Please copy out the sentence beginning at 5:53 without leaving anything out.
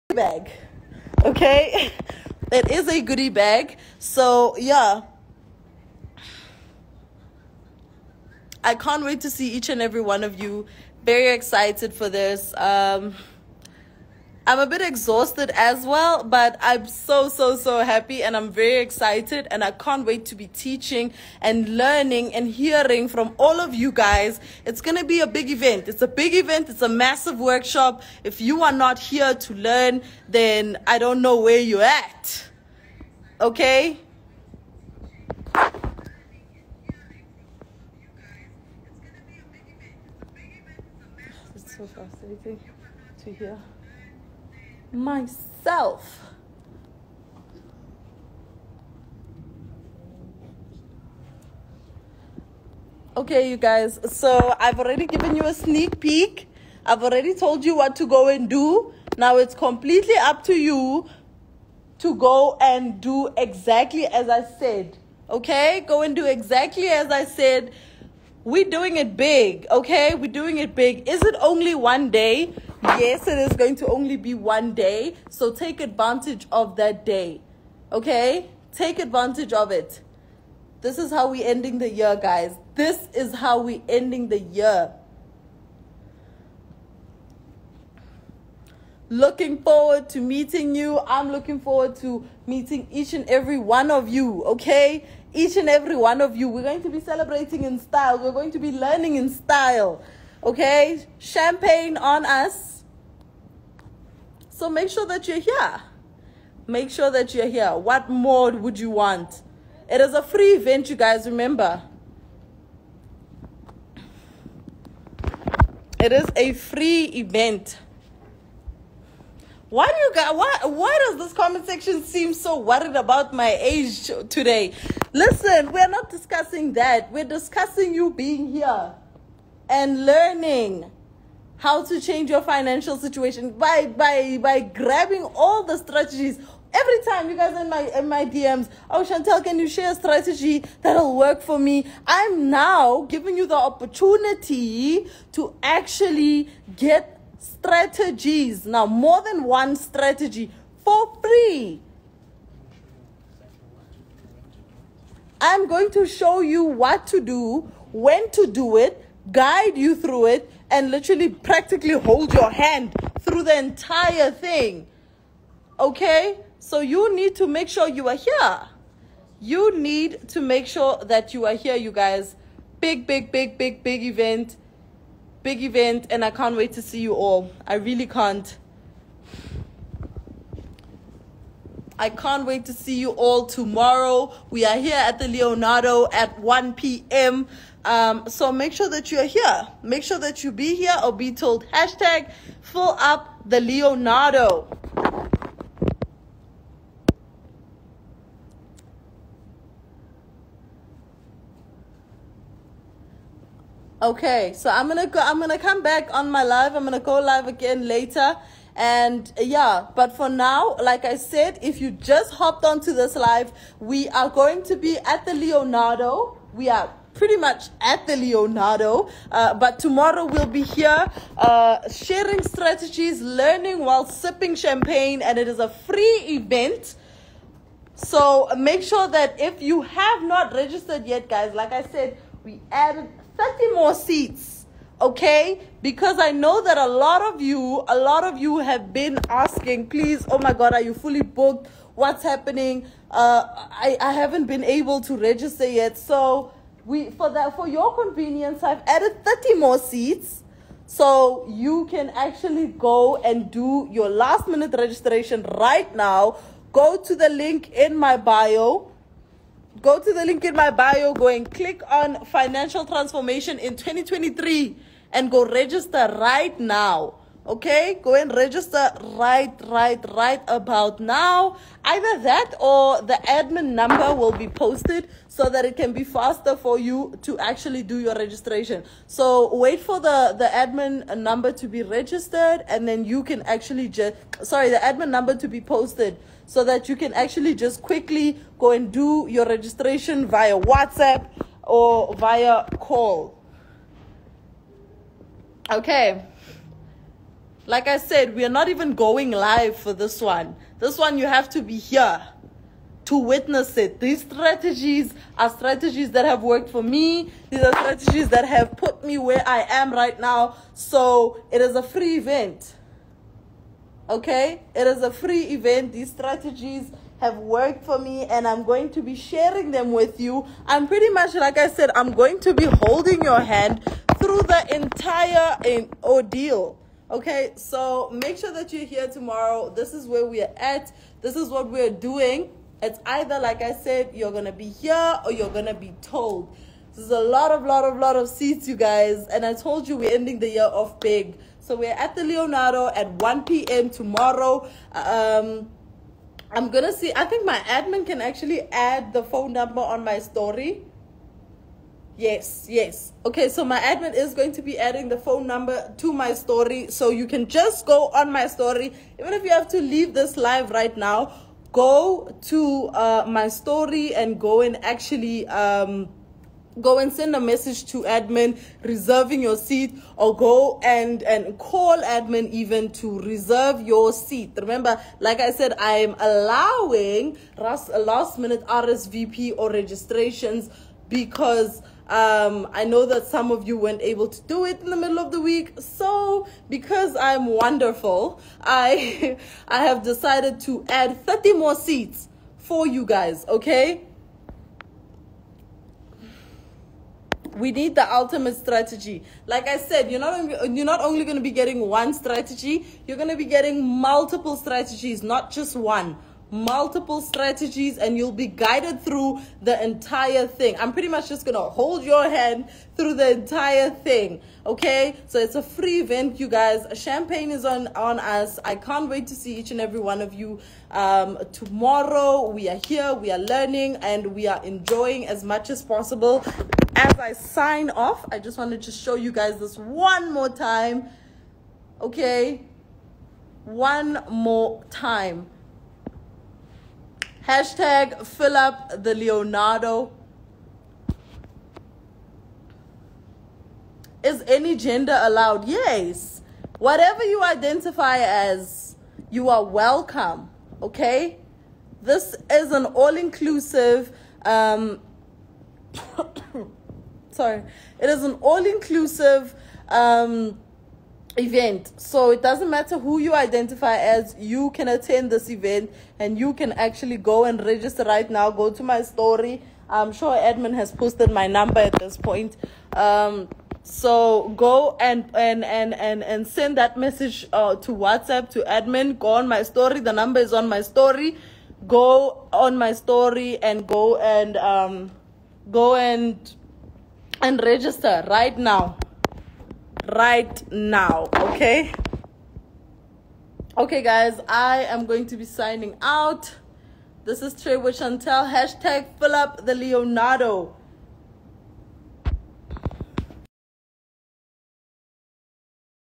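Okay, so my admin is going to be adding the phone number to my story.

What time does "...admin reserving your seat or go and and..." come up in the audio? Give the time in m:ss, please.
6:08.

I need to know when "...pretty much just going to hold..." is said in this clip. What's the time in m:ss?
6:50.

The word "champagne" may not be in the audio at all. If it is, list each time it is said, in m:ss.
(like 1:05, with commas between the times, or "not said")
1:41, 3:44, 6:57.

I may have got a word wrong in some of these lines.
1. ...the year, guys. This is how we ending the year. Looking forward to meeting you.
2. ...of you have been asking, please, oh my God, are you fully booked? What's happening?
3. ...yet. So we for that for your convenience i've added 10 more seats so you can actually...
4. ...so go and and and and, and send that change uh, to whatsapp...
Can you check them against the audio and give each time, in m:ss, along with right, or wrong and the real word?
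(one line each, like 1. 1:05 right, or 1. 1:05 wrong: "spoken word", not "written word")
1. 1:21 right
2. 3:58 right
3. 4:05 wrong: "30", not "10"
4. 7:53 wrong: "message", not "change".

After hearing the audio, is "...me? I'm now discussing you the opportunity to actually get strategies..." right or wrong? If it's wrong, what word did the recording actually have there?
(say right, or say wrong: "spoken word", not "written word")
wrong: "giving", not "discussing".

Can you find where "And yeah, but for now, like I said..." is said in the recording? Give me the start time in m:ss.
3:28.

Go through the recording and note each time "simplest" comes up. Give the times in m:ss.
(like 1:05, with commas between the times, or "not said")
not said.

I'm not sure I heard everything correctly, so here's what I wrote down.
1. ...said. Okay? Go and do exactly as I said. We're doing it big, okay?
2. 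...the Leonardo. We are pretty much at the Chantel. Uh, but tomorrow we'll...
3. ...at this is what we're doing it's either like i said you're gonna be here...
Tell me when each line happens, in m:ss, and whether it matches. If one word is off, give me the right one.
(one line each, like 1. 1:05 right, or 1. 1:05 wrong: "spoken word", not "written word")
1. 1:04 right
2. 3:35 wrong: "Leonardo", not "Chantel"
3. 5:30 right.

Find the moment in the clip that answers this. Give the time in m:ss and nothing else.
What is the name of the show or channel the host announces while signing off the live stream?
8:17.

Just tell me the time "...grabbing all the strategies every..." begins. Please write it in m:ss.
2:14.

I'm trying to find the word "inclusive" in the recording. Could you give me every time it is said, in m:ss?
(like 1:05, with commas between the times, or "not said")
7:33, 7:38.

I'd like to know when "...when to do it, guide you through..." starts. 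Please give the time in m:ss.
2:37.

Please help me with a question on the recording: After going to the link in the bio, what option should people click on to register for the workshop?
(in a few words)
financial transformation in 2023.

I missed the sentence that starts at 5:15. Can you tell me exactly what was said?
These strategies have worked for me and I'm going to be sharing them with you.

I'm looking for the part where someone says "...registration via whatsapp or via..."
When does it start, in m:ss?
4:49.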